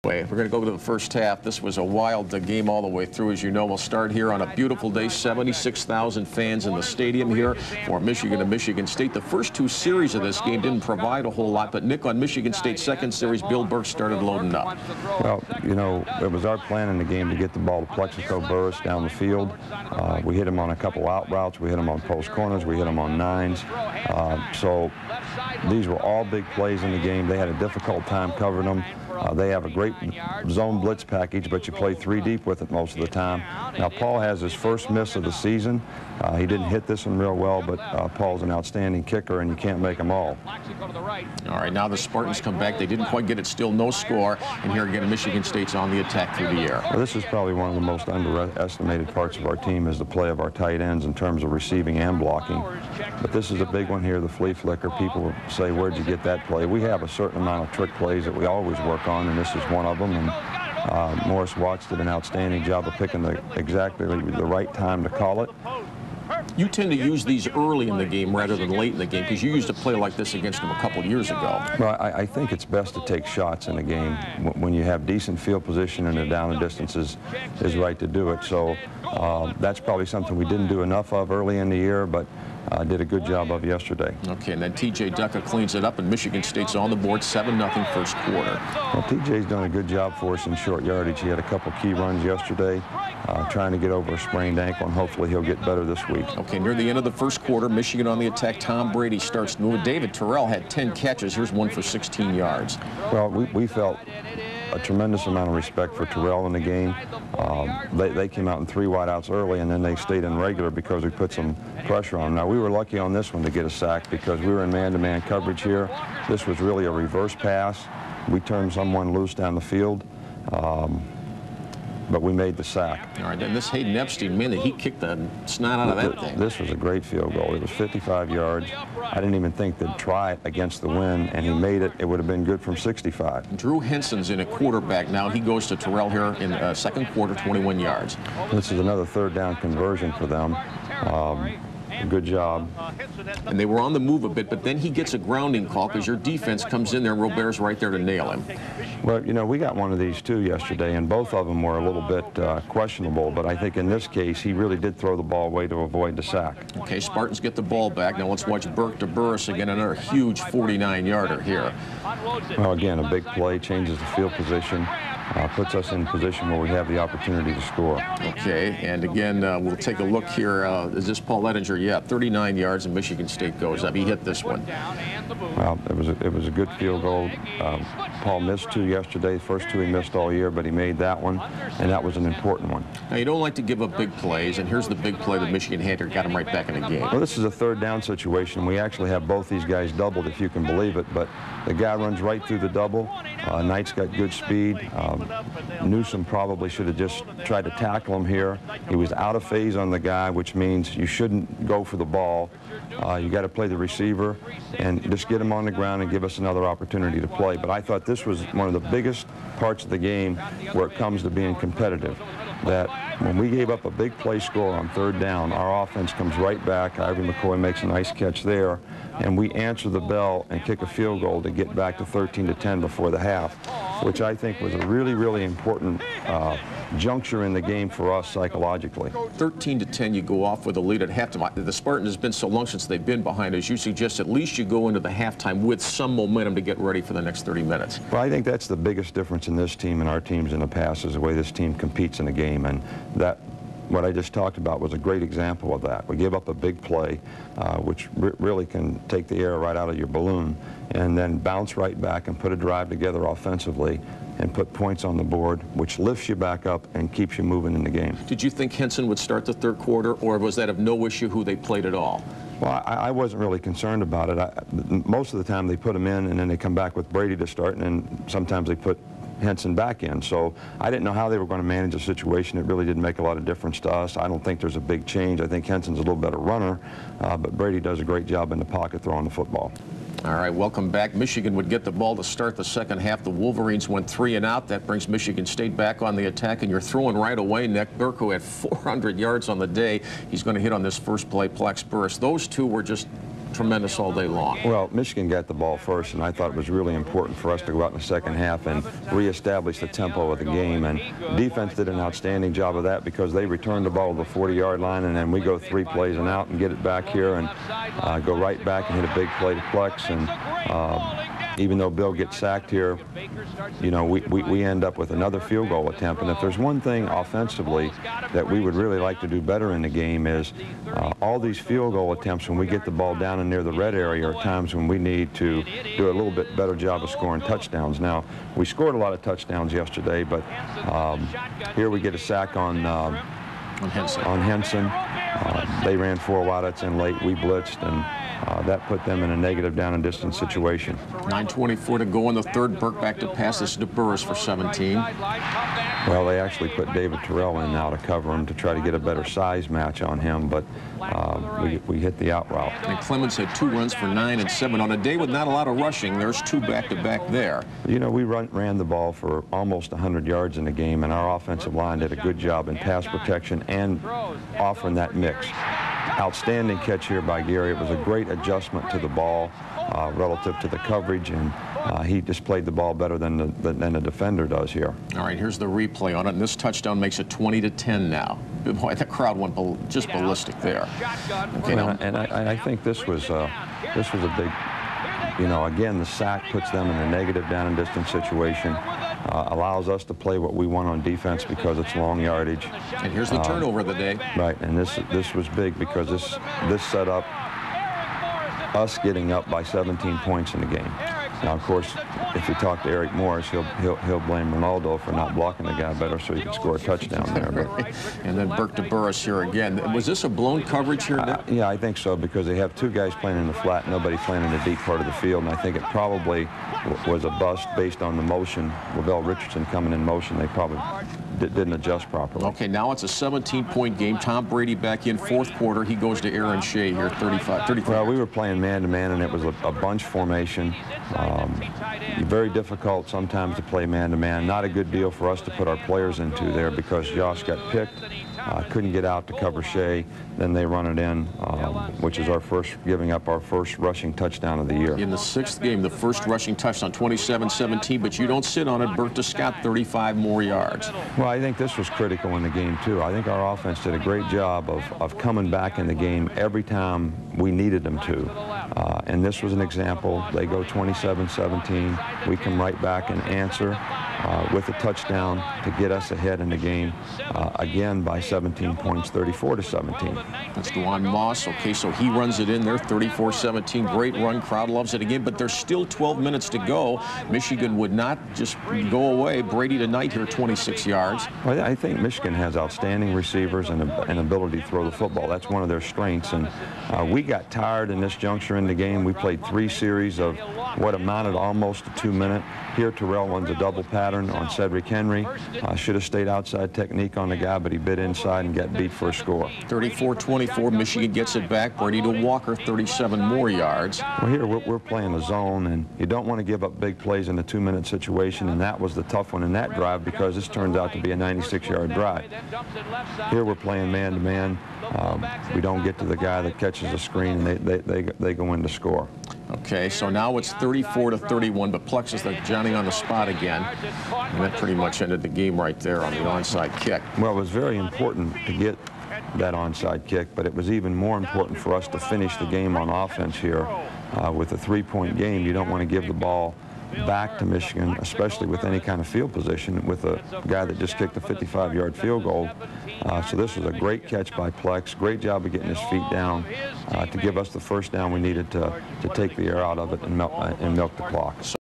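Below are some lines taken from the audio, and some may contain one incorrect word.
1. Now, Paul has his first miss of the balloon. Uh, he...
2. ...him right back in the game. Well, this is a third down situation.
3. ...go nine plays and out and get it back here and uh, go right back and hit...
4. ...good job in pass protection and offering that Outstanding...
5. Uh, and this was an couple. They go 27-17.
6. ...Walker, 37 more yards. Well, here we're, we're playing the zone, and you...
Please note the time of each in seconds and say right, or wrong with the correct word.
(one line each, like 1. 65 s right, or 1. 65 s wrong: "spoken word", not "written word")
1. 33 s wrong: "season", not "balloon"
2. 186 s right
3. 305 s wrong: "three", not "nine"
4. 362 s right
5. 458 s wrong: "example", not "couple"
6. 502 s right.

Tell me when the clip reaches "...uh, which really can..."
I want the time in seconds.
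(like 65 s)
247 s.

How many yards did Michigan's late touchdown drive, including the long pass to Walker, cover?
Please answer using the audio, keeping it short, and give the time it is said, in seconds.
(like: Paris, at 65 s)
96, at 511 s.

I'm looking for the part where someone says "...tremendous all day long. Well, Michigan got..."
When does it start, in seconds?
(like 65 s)
293 s.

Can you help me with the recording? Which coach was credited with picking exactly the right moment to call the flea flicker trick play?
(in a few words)
Morris Watts.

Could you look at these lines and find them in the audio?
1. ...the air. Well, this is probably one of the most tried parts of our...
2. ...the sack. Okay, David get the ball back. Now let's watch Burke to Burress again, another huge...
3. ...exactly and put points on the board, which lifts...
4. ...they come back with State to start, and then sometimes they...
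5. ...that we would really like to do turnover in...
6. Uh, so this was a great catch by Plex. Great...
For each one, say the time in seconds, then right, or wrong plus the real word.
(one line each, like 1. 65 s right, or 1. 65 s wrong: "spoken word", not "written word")
1. 46 s wrong: "underestimated", not "tried"
2. 156 s wrong: "Spartans", not "David"
3. 253 s wrong: "offensively", not "exactly"
4. 266 s wrong: "Brady", not "State"
5. 318 s wrong: "better", not "turnover"
6. 543 s right.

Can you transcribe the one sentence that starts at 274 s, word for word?
I don't think there's a big change.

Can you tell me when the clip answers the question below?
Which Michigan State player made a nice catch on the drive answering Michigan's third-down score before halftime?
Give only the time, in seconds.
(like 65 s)
216 s.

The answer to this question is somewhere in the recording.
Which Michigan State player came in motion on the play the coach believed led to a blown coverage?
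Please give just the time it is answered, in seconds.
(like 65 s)
418 s.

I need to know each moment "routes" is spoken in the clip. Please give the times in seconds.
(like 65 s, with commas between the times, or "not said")
21 s, 352 s.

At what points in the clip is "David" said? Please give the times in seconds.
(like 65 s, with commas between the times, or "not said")
99 s, 346 s.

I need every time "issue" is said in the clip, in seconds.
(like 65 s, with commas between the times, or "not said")
261 s.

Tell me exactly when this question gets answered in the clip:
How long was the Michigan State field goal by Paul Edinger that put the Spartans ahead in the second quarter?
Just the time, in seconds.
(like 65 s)
172 s.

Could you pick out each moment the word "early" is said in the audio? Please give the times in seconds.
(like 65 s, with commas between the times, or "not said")
67 s, 81 s, 109 s.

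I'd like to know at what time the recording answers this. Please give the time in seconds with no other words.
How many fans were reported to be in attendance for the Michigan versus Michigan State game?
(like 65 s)
5 s.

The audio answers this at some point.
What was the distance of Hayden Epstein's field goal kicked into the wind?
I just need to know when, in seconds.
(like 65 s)
127 s.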